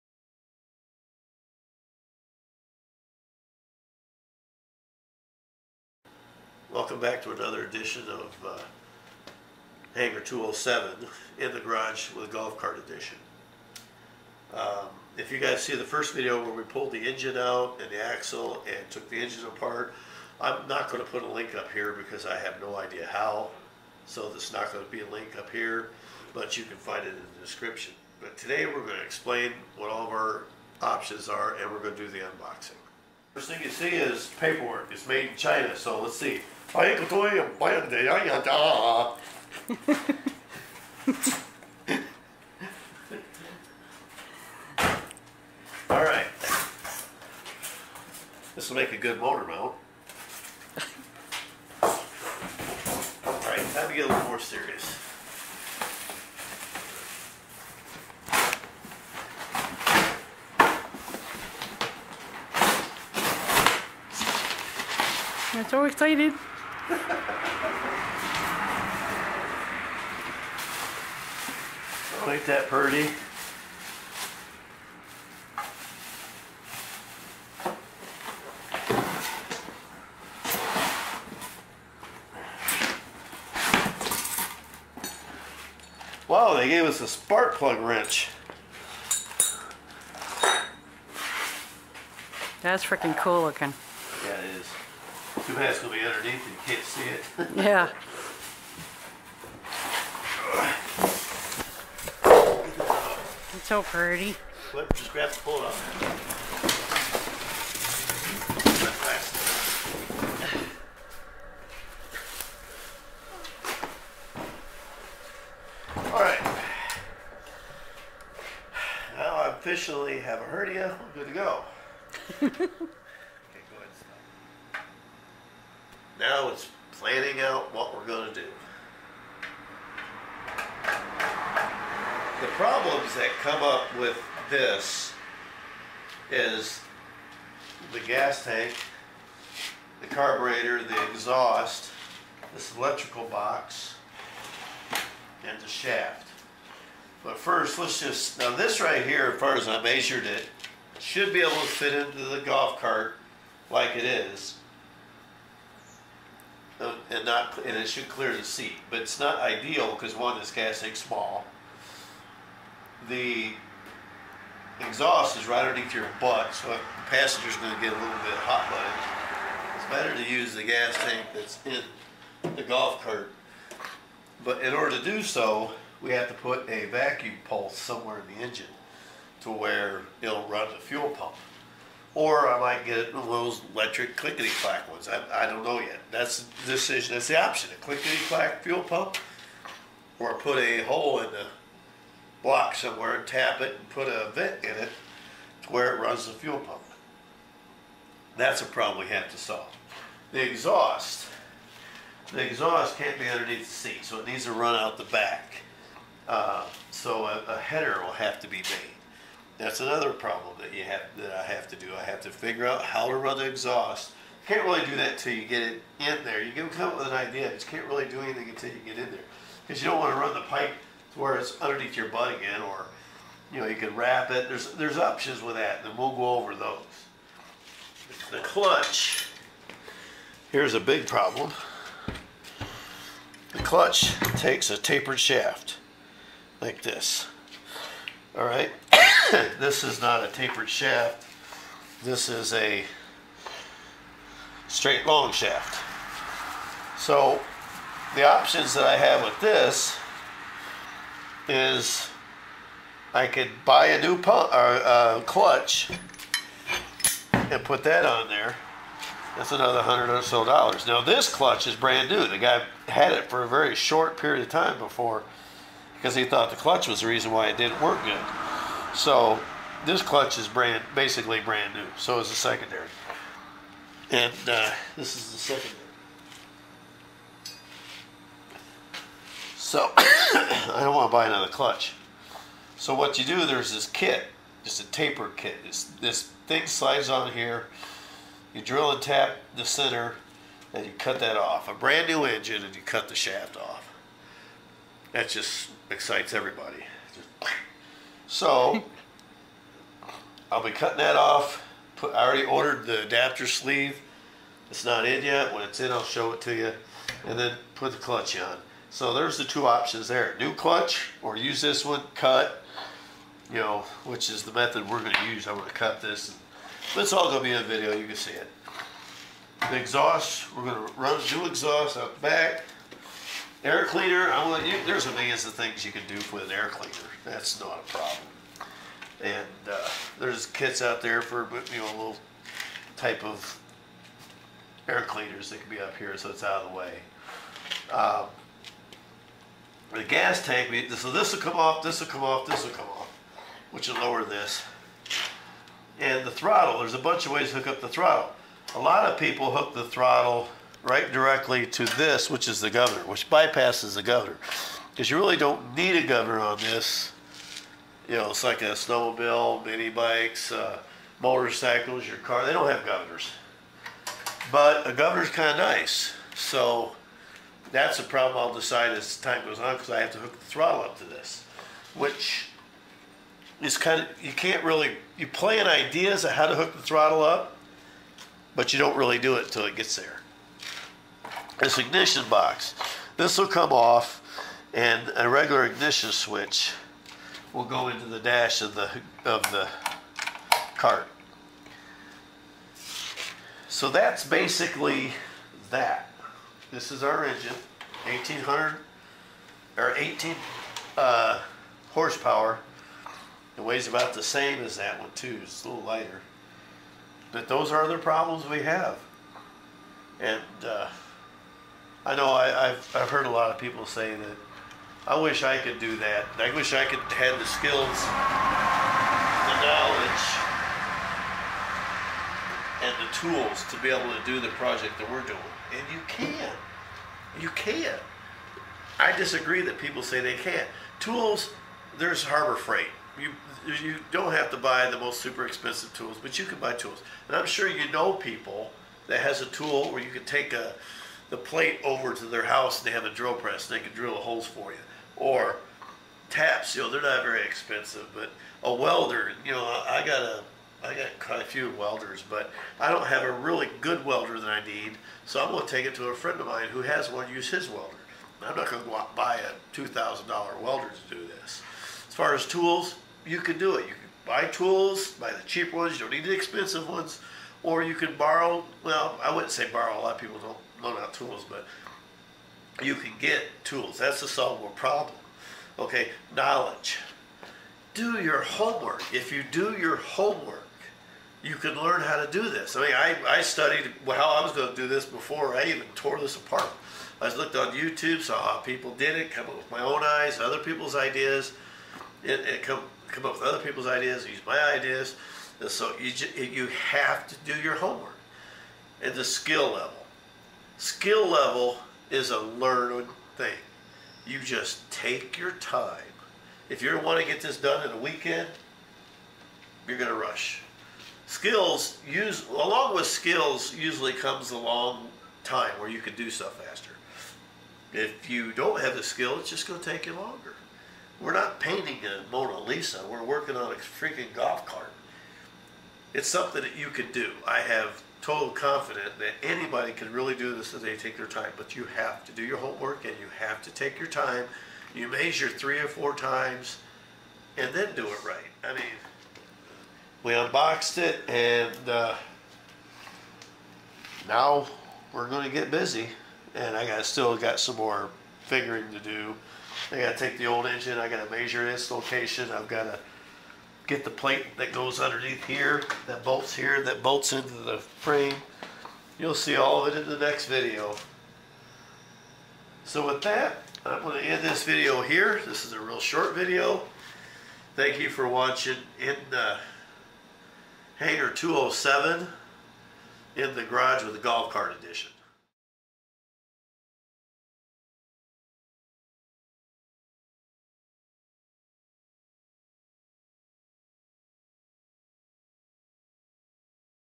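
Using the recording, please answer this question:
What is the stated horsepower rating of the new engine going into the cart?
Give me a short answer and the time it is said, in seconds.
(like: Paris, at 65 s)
18, at 399 s.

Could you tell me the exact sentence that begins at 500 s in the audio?
Skill level is a learned thing.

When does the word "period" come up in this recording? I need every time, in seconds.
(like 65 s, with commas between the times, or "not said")
264 s.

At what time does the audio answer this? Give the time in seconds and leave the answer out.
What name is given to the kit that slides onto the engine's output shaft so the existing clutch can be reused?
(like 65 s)
284 s.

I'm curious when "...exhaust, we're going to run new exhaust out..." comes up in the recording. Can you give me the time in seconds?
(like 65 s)
319 s.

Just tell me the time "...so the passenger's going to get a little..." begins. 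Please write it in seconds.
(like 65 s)
166 s.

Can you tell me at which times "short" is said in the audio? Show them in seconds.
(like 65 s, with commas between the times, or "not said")
263 s, 565 s.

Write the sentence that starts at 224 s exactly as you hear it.
There's there's options with that, and we'll go over those.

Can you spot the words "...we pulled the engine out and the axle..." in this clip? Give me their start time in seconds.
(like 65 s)
16 s.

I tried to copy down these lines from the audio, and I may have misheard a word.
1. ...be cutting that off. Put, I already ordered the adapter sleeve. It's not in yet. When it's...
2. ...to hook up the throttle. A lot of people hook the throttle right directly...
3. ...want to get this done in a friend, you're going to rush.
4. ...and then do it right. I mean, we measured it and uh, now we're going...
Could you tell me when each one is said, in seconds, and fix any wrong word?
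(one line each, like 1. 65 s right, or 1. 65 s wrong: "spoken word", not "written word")
1. 300 s right
2. 347 s right
3. 507 s wrong: "weekend", not "friend"
4. 537 s wrong: "unboxed", not "measured".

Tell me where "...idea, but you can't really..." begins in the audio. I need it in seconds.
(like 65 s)
217 s.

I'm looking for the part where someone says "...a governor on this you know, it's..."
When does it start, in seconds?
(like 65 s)
355 s.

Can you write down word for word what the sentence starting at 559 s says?
You'll see all of it in the next video.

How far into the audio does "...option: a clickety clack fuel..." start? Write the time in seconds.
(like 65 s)
187 s.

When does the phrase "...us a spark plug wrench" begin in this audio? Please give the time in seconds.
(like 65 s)
86 s.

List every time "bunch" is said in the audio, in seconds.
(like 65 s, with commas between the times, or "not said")
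346 s.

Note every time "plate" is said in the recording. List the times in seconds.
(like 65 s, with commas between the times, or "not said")
441 s, 554 s.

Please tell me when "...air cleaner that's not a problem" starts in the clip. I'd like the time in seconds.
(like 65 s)
326 s.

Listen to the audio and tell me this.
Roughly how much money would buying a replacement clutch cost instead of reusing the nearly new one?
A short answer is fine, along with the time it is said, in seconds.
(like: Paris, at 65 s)
100 dollars, at 259 s.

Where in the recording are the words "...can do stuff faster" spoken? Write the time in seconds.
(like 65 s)
516 s.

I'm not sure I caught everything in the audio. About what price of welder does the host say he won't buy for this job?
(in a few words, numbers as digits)
$2,000.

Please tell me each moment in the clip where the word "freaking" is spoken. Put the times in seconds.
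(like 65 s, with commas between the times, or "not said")
92 s, 523 s.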